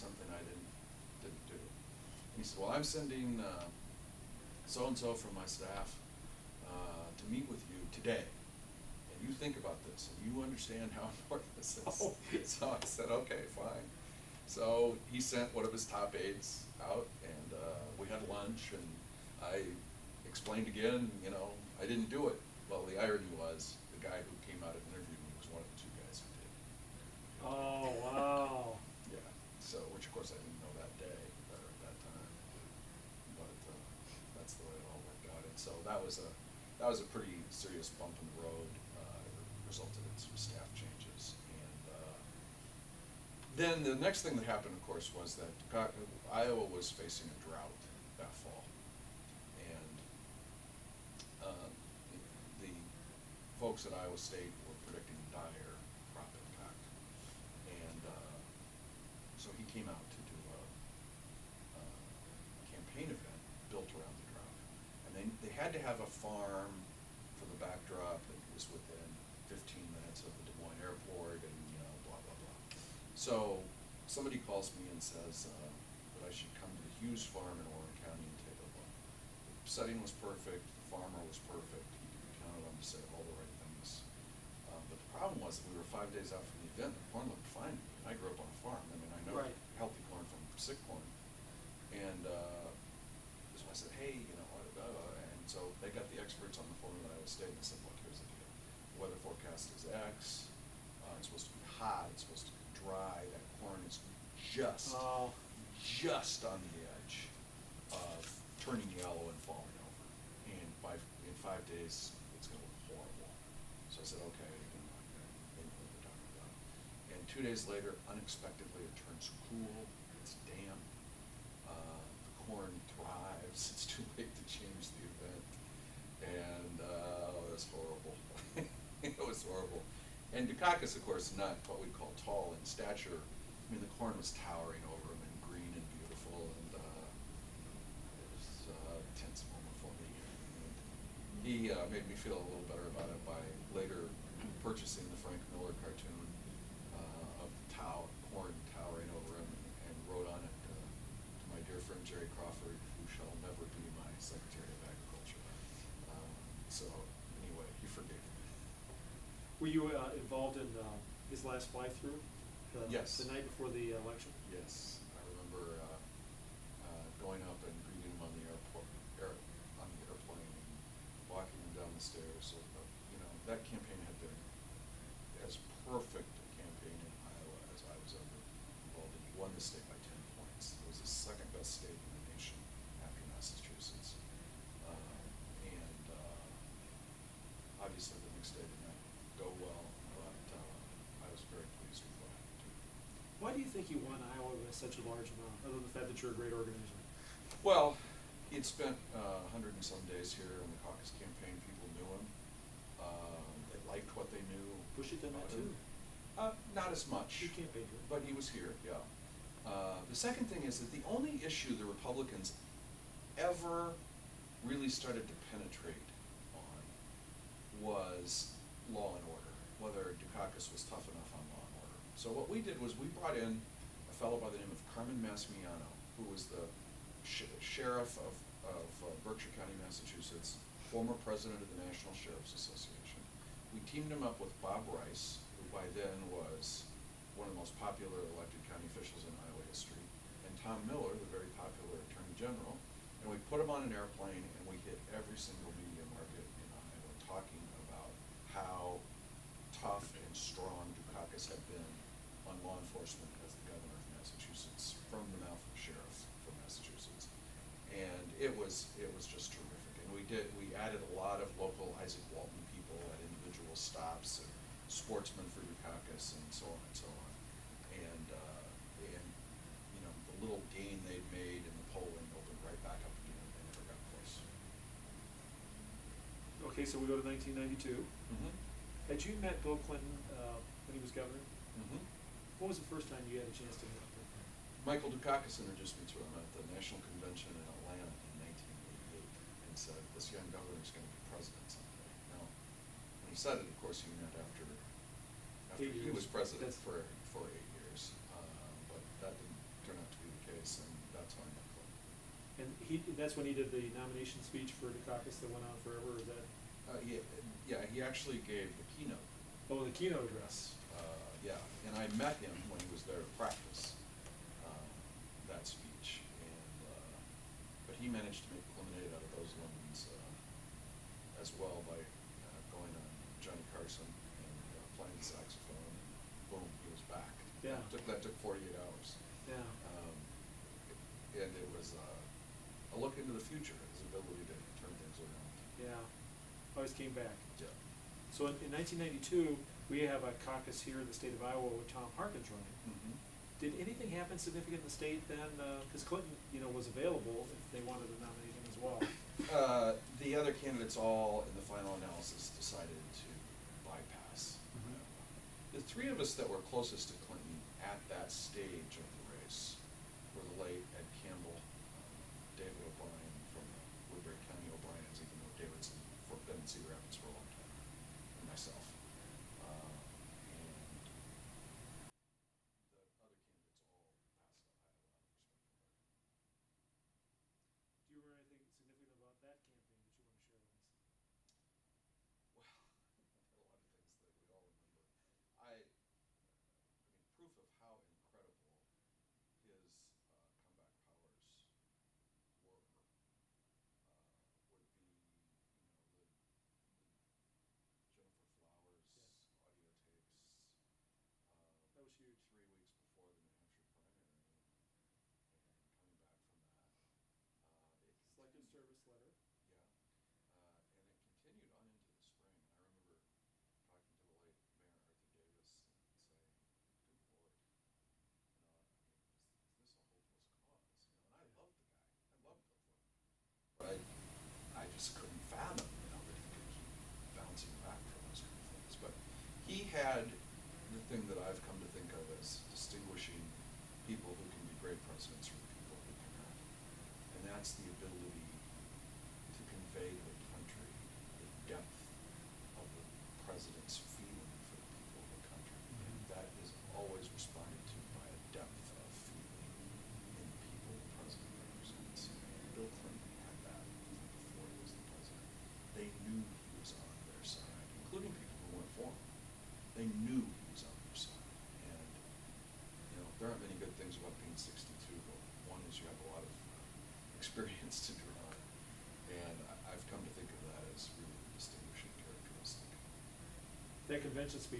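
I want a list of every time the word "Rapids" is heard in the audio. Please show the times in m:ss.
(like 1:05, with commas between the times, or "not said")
6:06.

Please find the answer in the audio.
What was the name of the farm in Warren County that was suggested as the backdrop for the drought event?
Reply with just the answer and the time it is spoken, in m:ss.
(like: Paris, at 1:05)
Hughes farm, at 1:17.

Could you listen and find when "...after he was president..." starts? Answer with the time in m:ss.
4:55.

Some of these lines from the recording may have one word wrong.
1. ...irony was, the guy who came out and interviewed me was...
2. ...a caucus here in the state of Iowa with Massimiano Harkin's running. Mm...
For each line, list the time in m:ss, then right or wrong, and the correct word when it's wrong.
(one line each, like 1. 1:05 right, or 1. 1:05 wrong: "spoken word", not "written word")
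1. 0:23 right
2. 5:40 wrong: "Tom", not "Massimiano".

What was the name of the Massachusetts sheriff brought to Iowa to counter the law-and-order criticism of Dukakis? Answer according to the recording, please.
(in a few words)
Carmen Massimiano.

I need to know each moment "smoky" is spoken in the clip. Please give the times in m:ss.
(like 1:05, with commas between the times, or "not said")
not said.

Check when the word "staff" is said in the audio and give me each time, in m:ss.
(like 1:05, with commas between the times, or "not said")
0:05, 0:40.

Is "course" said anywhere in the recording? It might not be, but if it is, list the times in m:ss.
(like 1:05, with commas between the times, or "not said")
0:30, 0:44, 2:11, 4:53.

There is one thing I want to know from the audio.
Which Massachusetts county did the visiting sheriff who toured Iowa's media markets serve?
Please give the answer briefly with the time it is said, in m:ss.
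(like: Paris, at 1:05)
Berkshire County, at 3:49.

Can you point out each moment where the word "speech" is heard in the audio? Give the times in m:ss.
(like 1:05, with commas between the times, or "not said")
5:04, 5:15.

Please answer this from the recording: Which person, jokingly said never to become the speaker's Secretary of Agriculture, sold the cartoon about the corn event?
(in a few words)
Jerry Crawford.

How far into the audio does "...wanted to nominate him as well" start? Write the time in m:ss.
5:47.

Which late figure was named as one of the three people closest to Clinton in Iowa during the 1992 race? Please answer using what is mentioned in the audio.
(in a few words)
Ed Campbell.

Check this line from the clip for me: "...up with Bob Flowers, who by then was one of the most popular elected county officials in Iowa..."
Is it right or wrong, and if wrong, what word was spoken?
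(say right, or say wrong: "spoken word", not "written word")
wrong: "Rice", not "Flowers".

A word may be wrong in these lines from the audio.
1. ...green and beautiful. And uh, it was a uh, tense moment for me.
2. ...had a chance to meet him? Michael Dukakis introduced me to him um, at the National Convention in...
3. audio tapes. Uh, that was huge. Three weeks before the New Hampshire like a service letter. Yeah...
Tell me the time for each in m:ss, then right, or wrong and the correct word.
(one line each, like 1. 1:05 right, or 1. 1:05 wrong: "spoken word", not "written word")
1. 2:15 right
2. 4:43 right
3. 6:39 right.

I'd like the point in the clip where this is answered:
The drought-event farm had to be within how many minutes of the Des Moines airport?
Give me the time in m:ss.
1:09.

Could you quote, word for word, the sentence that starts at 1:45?
just on the edge of turning yellow and falling over.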